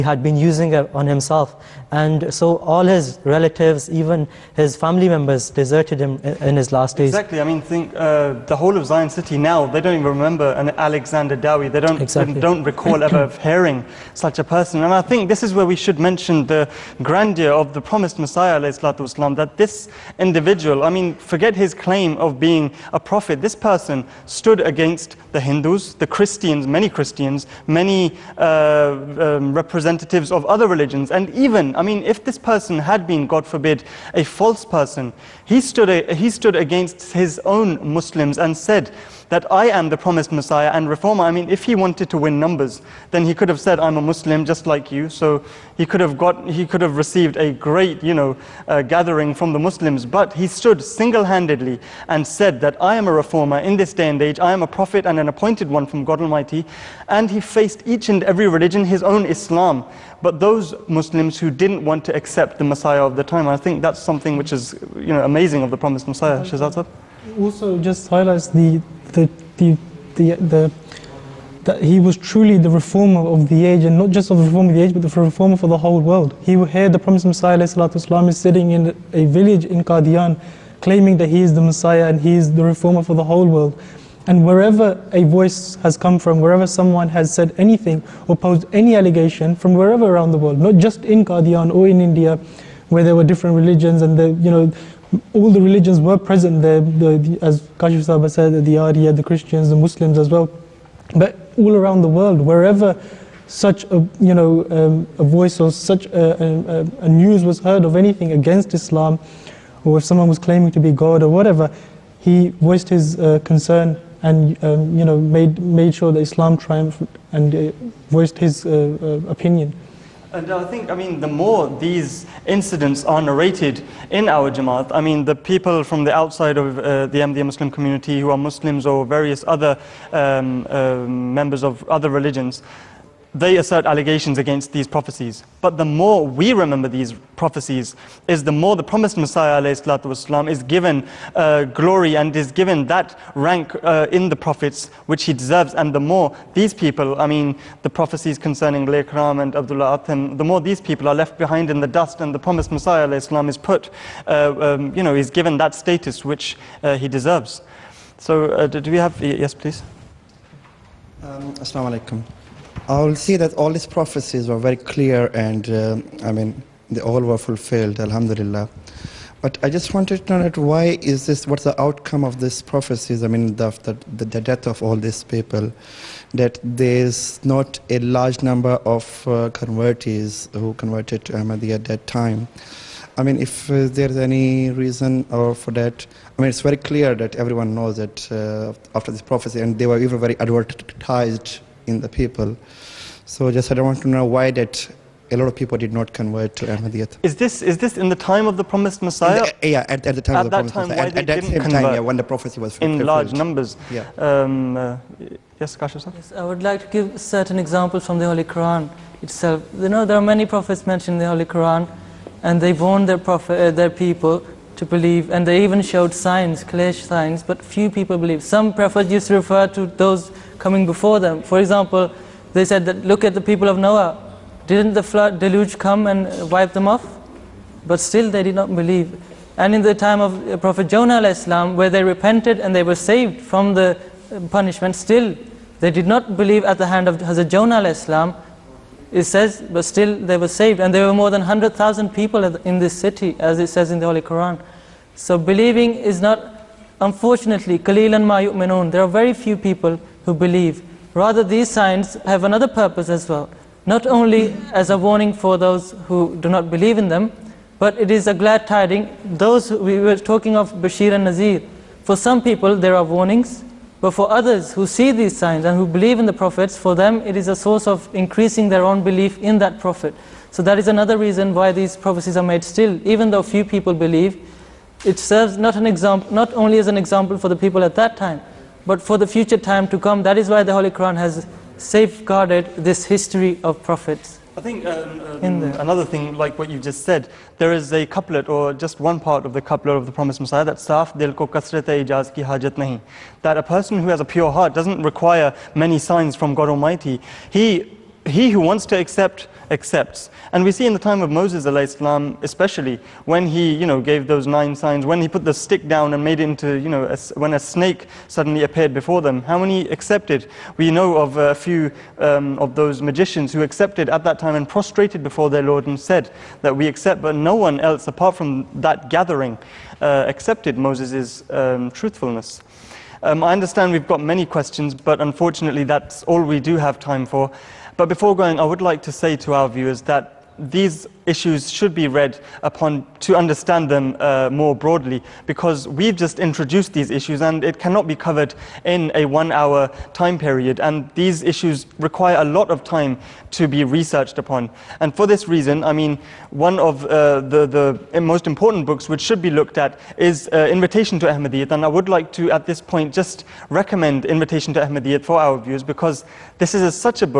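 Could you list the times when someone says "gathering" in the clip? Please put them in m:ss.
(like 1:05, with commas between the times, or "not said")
0:48, 5:19.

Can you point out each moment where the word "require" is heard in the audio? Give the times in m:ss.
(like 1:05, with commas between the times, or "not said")
4:55, 5:41.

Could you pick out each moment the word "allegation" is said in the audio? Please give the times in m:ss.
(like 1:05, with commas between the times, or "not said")
1:28, 2:13.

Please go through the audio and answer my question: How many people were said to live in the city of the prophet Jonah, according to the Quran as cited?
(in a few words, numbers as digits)
100,000.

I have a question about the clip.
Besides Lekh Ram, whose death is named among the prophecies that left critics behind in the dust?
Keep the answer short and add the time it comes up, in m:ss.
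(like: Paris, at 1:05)
Abdullah Atham, at 2:29.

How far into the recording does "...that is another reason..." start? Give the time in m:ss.
4:30.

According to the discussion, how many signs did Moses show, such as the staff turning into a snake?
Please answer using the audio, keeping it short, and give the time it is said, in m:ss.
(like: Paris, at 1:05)
9, at 5:04.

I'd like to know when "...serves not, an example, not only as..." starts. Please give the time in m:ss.
4:35.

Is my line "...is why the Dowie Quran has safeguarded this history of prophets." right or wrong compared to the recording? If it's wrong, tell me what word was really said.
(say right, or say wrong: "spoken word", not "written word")
wrong: "Holy", not "Dowie".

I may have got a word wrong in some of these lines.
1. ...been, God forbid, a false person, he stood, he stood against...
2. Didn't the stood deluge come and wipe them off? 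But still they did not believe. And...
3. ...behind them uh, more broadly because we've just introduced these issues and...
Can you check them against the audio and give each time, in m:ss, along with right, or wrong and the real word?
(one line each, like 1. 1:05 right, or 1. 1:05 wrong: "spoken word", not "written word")
1. 0:33 right
2. 3:44 wrong: "flood", not "stood"
3. 5:33 wrong: "understand", not "behind".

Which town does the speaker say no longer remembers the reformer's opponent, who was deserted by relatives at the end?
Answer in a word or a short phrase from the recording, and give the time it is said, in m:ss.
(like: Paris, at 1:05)
Zion City, at 0:08.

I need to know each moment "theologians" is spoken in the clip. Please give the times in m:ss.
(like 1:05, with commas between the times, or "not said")
not said.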